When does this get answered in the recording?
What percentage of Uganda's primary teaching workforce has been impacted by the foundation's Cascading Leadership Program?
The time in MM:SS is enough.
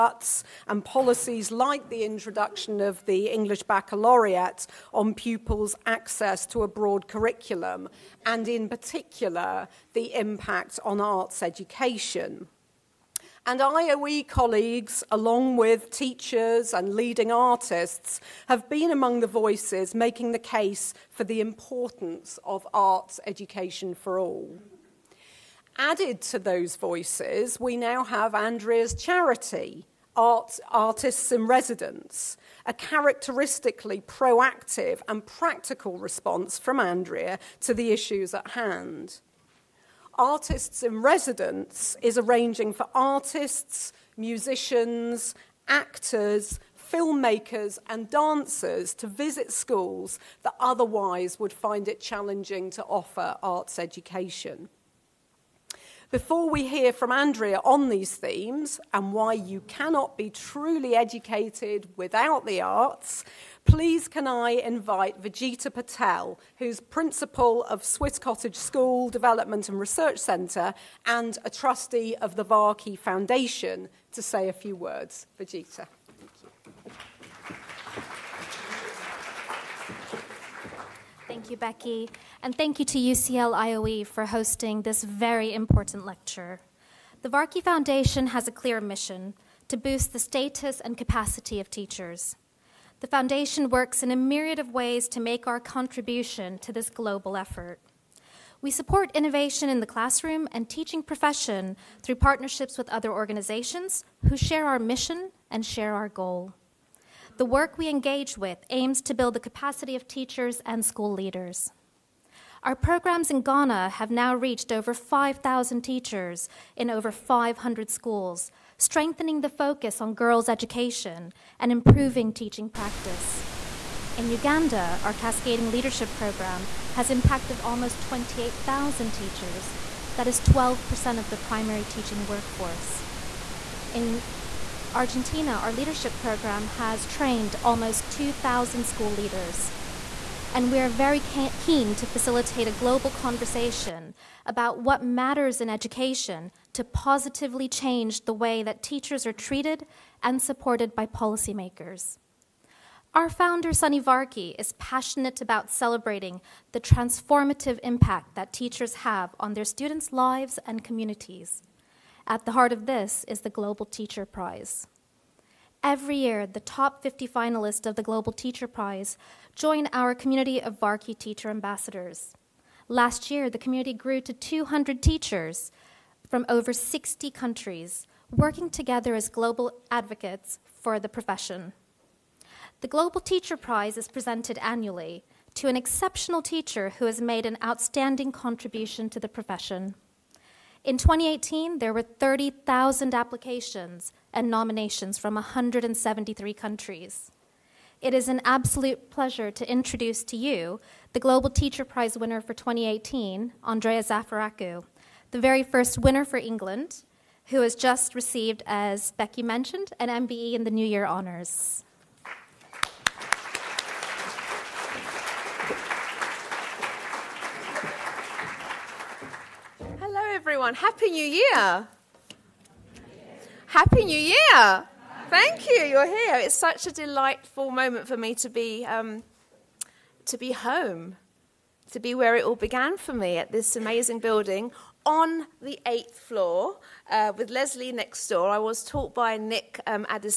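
02:10.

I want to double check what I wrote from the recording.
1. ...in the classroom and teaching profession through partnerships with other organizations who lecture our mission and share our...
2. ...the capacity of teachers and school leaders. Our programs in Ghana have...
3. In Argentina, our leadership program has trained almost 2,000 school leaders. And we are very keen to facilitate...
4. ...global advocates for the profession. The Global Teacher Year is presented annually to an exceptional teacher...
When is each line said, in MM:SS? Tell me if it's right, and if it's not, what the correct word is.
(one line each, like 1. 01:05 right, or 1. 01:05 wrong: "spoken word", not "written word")
1. 01:39 wrong: "share", not "lecture"
2. 01:49 right
3. 02:13 right
4. 02:59 wrong: "Prize", not "Year".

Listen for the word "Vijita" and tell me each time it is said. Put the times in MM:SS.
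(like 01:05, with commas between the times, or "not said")
01:05, 01:15.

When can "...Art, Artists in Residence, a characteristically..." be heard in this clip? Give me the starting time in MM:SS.
00:30.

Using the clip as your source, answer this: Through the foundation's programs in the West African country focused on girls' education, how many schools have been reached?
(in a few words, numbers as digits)
500.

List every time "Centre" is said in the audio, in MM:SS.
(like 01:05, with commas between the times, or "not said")
01:10.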